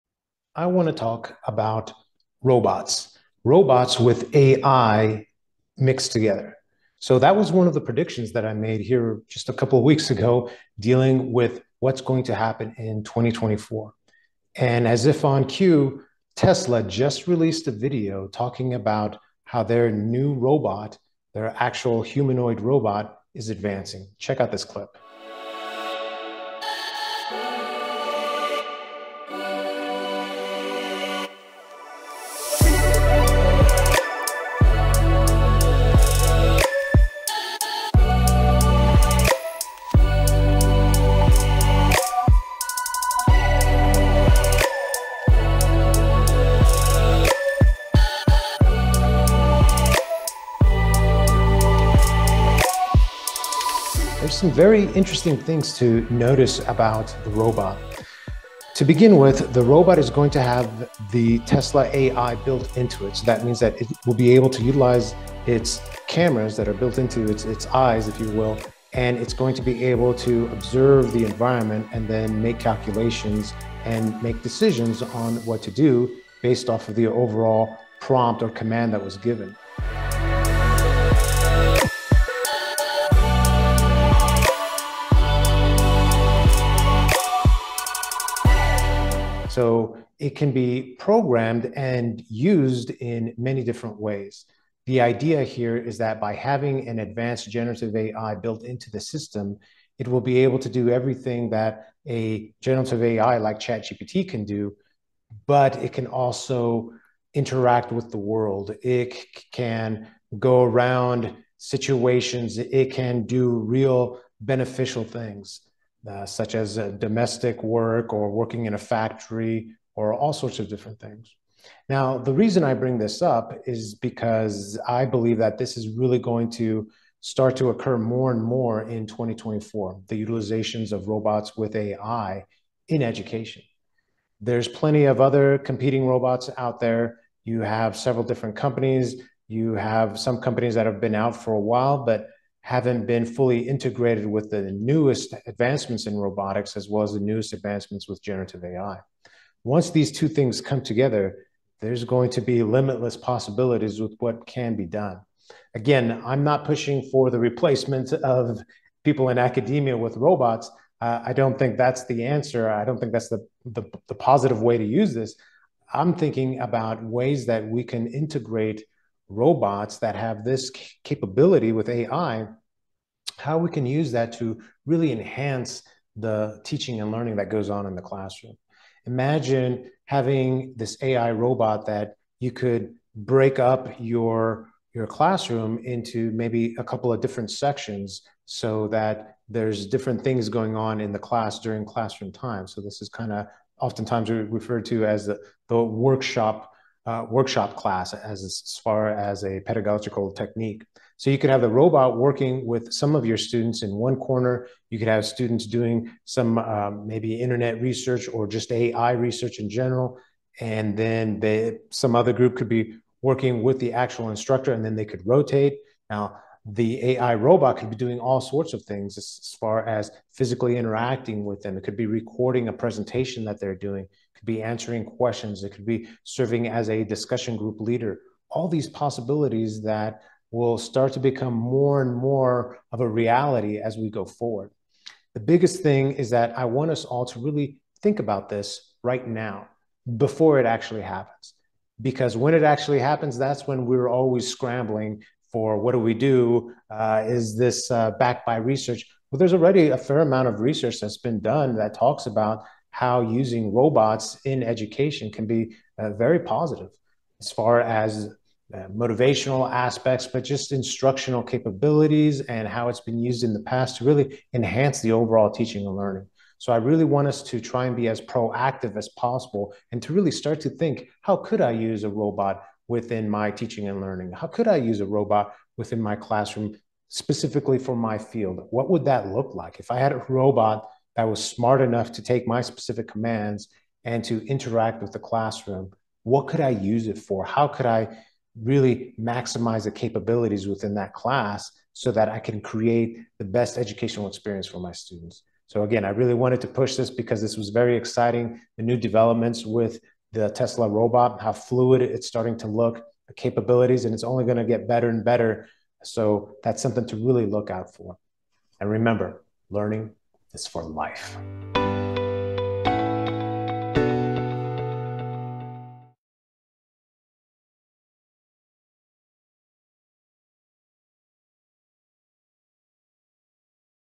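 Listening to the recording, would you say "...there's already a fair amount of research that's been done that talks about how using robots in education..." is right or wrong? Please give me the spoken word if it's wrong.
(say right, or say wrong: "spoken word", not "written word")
right.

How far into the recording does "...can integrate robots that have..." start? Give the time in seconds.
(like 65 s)
167 s.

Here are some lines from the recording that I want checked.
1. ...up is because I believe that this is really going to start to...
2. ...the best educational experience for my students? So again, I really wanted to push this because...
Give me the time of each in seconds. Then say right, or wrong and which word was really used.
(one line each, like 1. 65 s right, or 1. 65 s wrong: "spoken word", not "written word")
1. 123 s right
2. 293 s right.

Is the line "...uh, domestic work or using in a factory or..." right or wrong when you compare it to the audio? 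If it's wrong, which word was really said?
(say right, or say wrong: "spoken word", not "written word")
wrong: "working", not "using".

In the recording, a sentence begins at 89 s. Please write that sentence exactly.
So it can be programmed and used in many different ways.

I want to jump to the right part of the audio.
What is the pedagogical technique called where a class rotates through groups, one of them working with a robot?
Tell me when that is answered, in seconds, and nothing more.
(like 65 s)
197 s.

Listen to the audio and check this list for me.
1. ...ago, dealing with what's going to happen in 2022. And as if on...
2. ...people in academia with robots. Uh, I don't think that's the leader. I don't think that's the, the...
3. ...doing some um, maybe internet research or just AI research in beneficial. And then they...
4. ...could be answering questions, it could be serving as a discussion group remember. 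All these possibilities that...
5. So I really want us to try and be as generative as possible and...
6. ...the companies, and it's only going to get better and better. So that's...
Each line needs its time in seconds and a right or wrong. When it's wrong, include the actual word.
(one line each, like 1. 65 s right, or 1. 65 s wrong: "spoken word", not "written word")
1. 10 s wrong: "2024", not "2022"
2. 159 s wrong: "answer", not "leader"
3. 205 s wrong: "general", not "beneficial"
4. 224 s wrong: "leader", not "remember"
5. 266 s wrong: "proactive", not "generative"
6. 303 s wrong: "capabilities", not "companies".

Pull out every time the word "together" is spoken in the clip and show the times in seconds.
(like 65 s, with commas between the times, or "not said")
6 s, 150 s.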